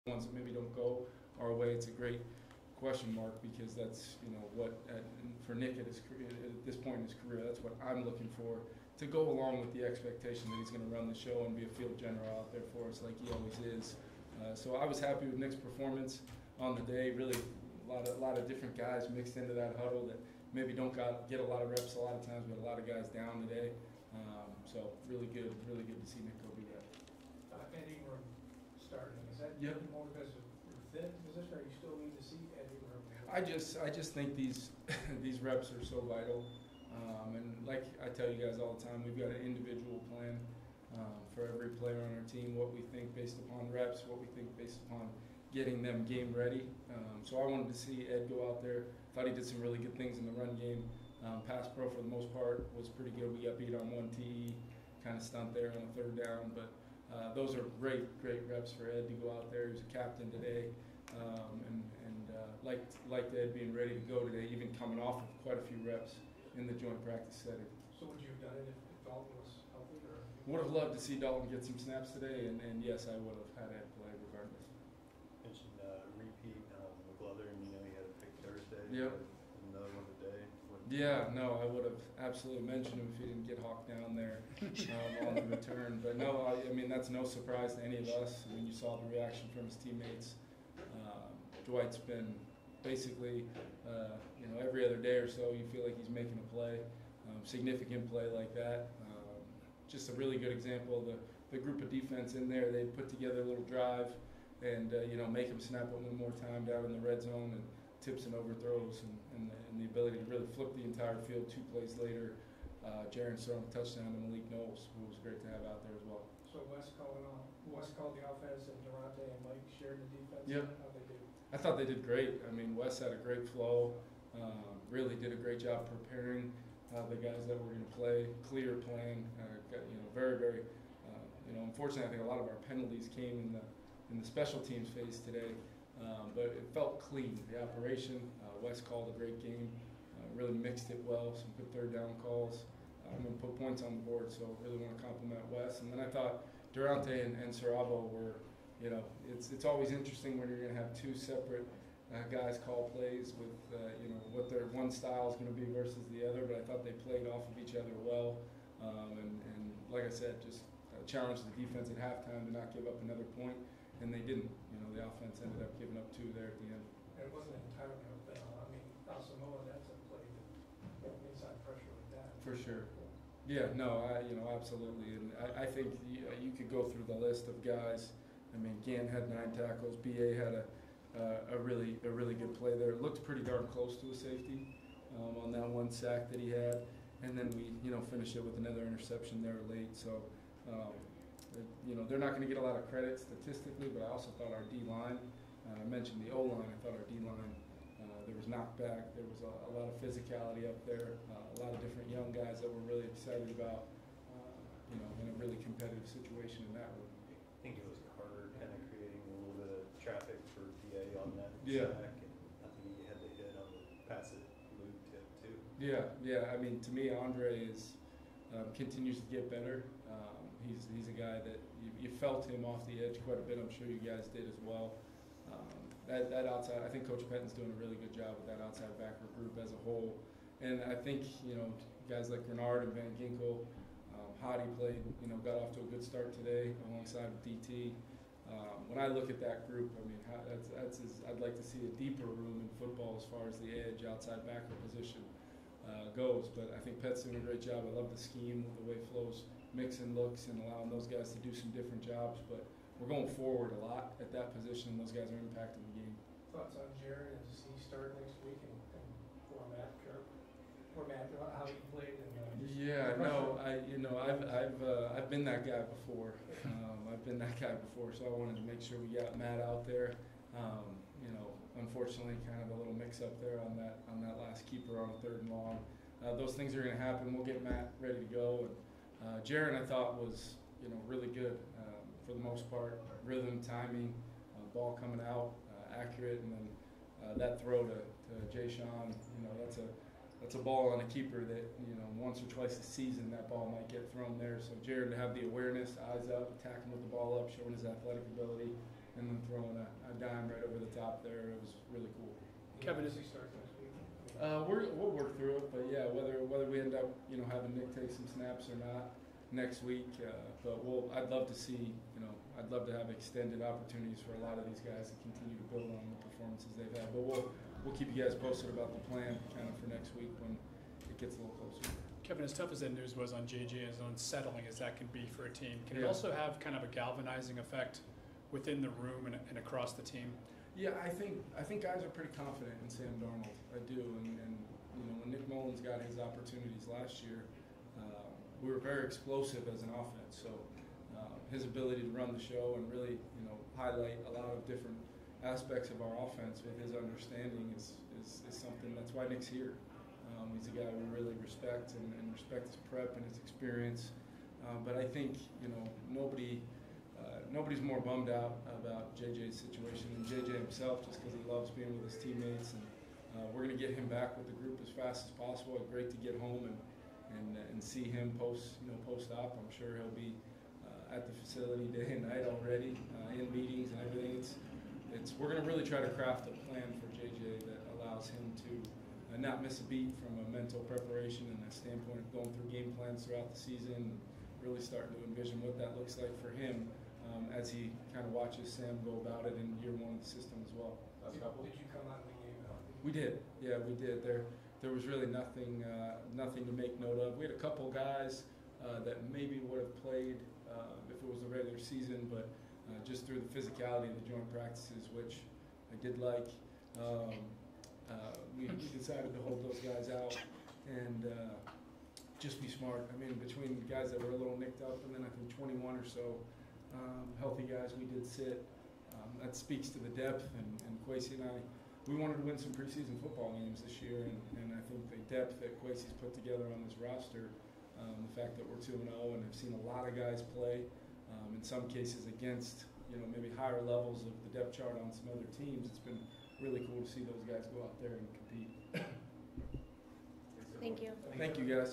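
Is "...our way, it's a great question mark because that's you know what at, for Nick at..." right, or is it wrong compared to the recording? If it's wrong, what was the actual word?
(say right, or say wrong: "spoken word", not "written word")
right.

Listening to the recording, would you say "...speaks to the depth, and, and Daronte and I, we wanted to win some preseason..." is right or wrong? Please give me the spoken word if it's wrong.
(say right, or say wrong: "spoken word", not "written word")
wrong: "Kwesi", not "Daronte".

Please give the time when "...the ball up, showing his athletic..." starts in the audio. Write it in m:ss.
4:57.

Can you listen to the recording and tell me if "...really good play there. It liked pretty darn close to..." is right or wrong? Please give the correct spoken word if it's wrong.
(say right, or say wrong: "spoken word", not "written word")
wrong: "looked", not "liked".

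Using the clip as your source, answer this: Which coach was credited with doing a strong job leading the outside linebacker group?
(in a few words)
Coach Patton.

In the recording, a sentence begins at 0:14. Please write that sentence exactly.
Uh, so I was happy with Nick's performance on the day.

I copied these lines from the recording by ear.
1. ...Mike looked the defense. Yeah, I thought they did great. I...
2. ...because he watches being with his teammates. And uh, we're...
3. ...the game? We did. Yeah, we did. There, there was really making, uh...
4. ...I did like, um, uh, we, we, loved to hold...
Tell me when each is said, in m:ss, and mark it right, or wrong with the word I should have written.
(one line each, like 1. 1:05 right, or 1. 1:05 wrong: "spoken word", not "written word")
1. 1:59 wrong: "shared", not "looked"
2. 6:01 wrong: "loves", not "watches"
3. 6:32 wrong: "nothing", not "making"
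4. 6:45 wrong: "decided", not "loved".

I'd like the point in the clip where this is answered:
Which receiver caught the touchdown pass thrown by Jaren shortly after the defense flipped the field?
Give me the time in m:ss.
1:54.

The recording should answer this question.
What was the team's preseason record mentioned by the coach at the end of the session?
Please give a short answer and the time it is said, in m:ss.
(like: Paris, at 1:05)
2-0, at 7:08.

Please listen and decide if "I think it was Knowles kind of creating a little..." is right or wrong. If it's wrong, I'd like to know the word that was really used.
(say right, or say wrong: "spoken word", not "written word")
wrong: "Carter", not "Knowles".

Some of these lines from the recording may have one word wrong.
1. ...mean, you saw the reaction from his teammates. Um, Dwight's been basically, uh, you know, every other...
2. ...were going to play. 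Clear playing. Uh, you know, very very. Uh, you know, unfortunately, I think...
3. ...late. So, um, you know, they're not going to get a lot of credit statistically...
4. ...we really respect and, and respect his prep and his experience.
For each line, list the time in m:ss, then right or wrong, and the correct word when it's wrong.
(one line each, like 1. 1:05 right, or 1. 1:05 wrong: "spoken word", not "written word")
1. 1:28 right
2. 2:07 right
3. 3:09 right
4. 5:50 right.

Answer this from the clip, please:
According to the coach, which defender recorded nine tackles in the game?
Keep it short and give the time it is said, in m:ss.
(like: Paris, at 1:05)
Gann, at 2:58.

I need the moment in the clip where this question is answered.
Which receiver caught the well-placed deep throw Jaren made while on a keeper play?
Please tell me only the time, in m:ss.
4:48.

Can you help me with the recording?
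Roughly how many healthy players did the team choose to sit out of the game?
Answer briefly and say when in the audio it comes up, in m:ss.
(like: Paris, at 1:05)
21, at 6:55.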